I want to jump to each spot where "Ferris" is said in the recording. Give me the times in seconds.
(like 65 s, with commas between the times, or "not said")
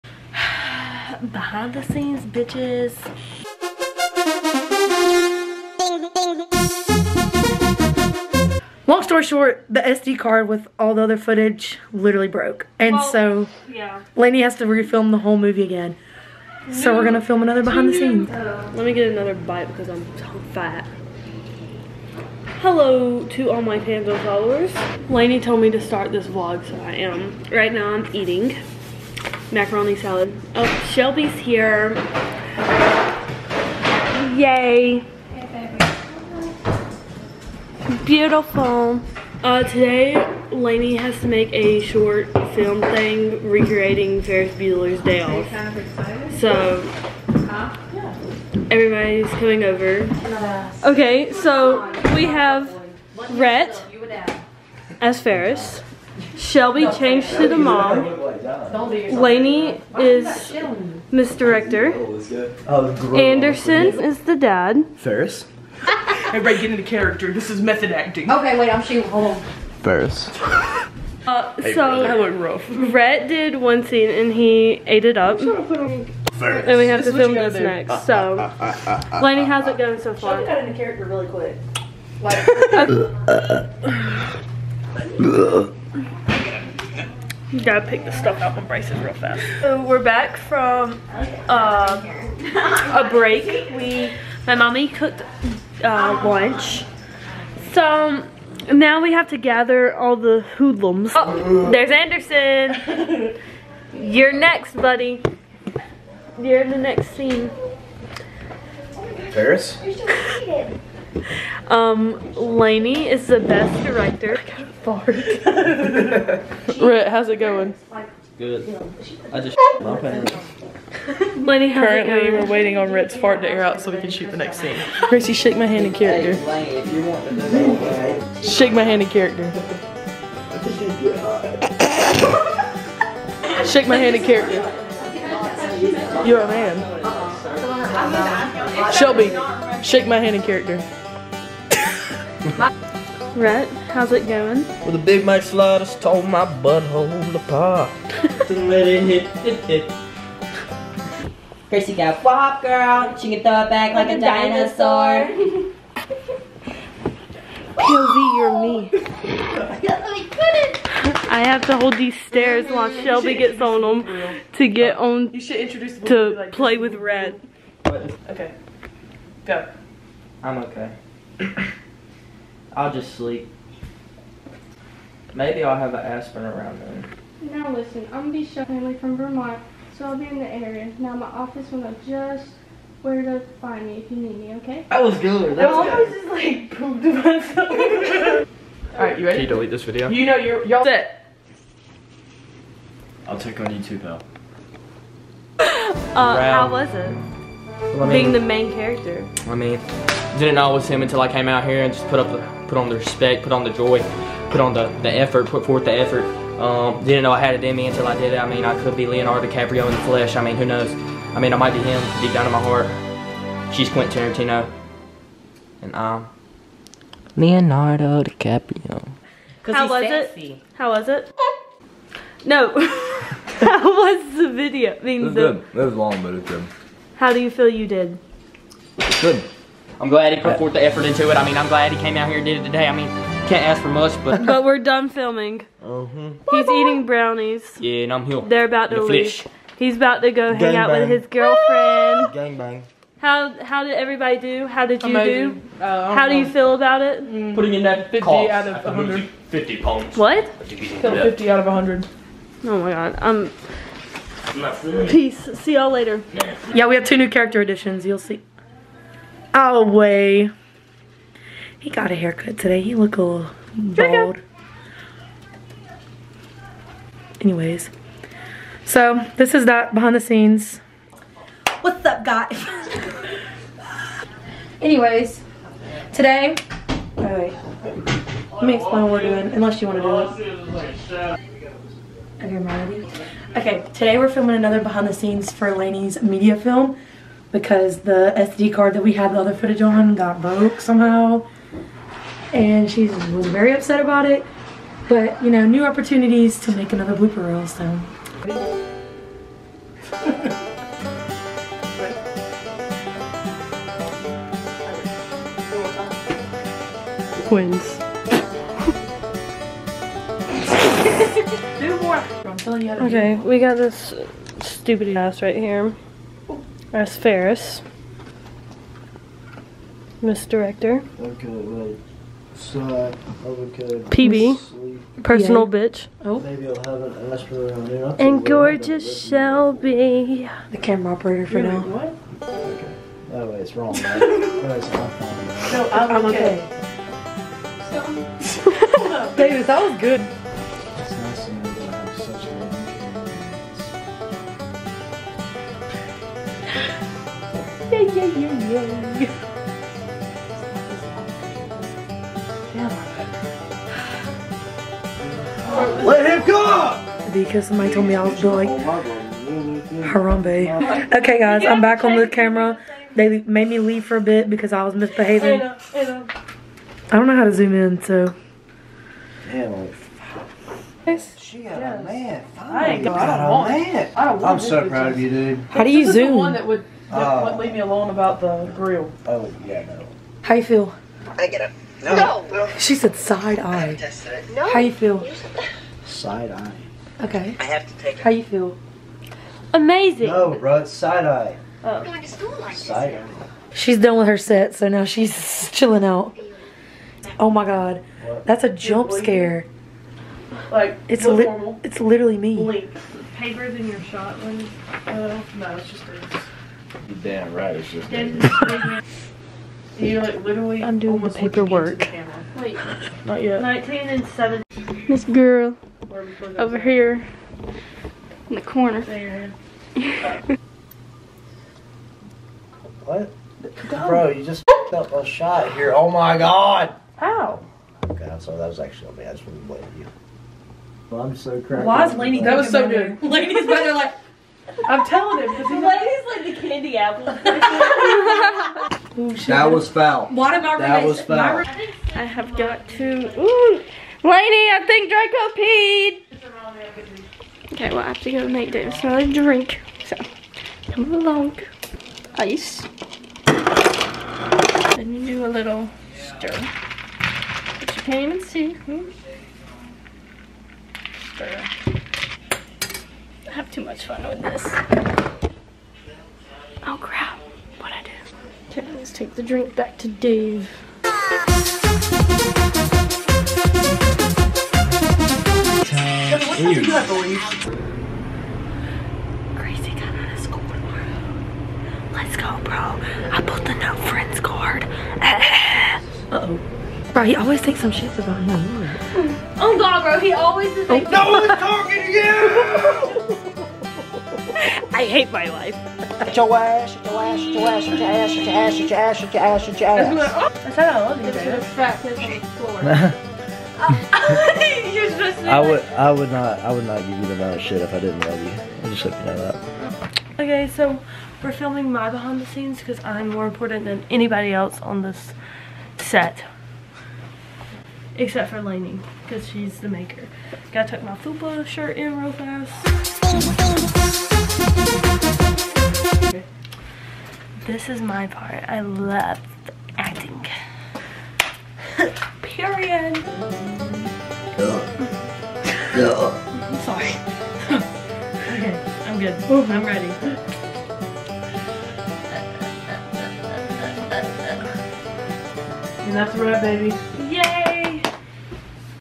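44 s, 55 s, 64 s, 69 s, 317 s.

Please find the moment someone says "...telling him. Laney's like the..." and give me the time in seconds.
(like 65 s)
435 s.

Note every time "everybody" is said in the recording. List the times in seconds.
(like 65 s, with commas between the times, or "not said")
48 s, 66 s, 244 s.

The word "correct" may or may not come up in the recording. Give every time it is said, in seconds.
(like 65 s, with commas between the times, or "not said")
not said.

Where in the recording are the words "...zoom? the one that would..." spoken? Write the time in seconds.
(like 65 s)
376 s.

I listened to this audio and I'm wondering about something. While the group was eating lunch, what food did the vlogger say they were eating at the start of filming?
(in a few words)
Macaroni salad.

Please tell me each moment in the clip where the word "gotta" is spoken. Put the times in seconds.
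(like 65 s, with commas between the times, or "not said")
87 s, 520 s.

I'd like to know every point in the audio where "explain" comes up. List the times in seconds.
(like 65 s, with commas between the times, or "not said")
278 s.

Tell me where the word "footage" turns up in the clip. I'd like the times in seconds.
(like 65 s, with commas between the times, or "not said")
11 s, 289 s.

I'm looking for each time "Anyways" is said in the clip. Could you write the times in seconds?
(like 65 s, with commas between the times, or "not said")
267 s, 274 s.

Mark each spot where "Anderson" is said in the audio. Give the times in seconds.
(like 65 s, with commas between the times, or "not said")
63 s, 101 s.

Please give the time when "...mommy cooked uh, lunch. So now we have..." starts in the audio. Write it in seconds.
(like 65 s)
94 s.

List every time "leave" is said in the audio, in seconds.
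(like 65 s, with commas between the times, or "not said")
239 s, 363 s, 377 s, 477 s.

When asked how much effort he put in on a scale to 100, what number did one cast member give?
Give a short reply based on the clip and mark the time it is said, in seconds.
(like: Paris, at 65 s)
50, at 250 s.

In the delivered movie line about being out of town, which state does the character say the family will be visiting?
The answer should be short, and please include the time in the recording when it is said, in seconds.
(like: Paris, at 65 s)
Vermont, at 179 s.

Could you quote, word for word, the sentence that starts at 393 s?
She's done with her set, so now she's chilling out.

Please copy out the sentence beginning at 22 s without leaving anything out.
Hello to all my fans followers.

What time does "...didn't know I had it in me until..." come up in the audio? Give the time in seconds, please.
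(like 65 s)
207 s.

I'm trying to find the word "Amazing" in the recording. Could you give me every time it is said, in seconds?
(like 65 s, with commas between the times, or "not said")
245 s, 389 s.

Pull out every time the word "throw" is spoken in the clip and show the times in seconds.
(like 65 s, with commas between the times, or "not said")
153 s.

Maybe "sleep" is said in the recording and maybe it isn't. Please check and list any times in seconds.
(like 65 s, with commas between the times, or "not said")
173 s.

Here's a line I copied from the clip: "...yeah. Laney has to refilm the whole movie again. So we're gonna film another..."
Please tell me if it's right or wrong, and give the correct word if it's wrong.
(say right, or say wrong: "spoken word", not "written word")
right.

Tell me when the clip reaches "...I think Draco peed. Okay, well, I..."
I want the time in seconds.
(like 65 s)
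444 s.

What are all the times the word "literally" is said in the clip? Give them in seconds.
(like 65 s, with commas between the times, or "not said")
11 s, 402 s, 410 s.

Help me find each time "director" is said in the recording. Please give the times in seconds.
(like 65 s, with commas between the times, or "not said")
61 s, 113 s, 320 s.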